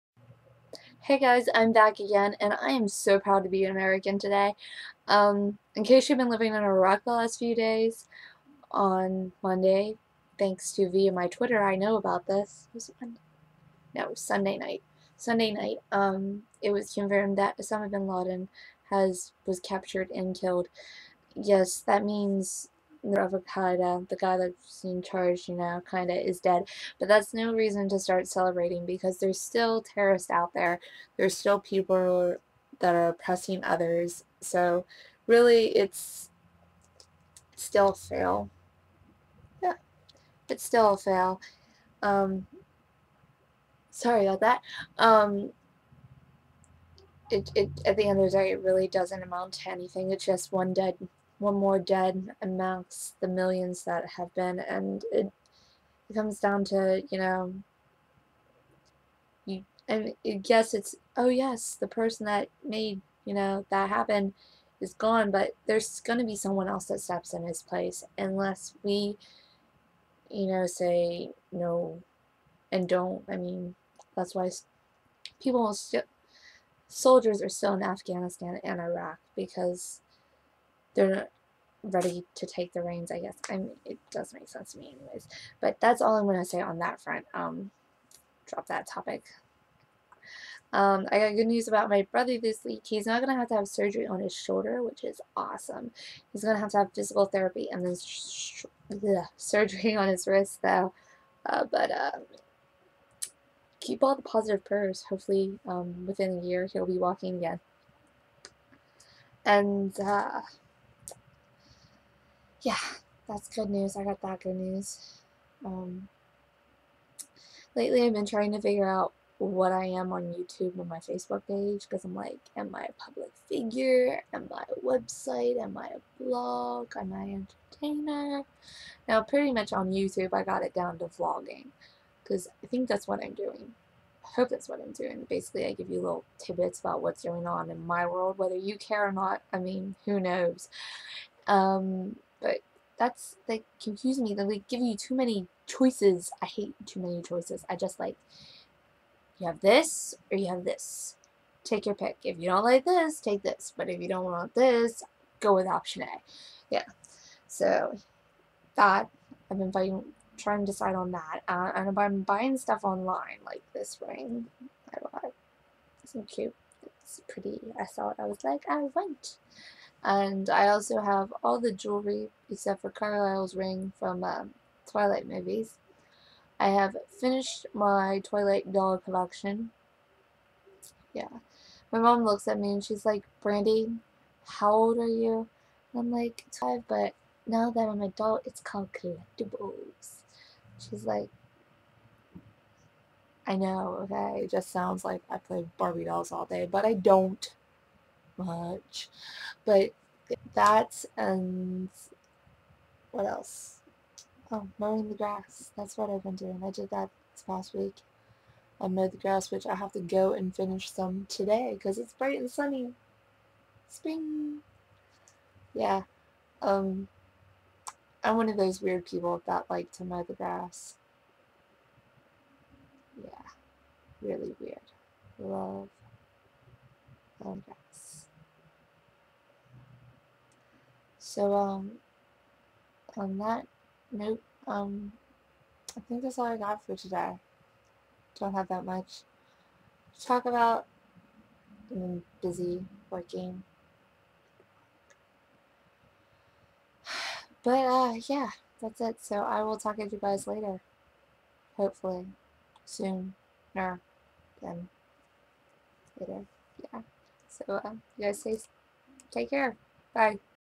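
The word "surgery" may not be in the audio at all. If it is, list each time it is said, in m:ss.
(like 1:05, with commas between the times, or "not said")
1:33, 1:39.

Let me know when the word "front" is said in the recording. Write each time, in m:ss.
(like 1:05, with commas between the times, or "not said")
1:27.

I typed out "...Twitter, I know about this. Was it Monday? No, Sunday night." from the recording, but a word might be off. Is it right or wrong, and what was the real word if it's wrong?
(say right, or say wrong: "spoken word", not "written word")
right.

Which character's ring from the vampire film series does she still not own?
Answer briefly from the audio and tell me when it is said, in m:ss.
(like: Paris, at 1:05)
Carlisle, at 2:52.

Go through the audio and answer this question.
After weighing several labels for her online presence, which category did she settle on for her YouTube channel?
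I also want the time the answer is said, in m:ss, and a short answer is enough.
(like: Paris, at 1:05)
Vlogging, at 2:11.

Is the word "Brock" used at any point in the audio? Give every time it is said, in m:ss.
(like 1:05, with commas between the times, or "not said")
not said.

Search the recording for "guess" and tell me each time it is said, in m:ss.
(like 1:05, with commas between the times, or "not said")
1:23.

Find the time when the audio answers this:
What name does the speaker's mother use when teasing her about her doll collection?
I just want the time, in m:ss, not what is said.
3:03.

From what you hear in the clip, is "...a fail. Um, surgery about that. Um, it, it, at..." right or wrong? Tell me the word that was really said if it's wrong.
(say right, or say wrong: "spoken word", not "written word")
wrong: "sorry", not "surgery".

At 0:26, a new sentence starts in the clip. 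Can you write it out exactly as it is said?
But that's no reason to start celebrating because there's still terrorists out there.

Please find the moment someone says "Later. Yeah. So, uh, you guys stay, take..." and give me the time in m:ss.
4:16.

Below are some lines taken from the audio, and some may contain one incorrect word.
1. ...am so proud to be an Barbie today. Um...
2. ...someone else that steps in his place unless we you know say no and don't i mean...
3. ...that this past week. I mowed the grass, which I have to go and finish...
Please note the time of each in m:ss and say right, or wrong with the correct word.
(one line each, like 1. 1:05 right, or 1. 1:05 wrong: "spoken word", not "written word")
1. 0:02 wrong: "American", not "Barbie"
2. 1:06 right
3. 3:26 right.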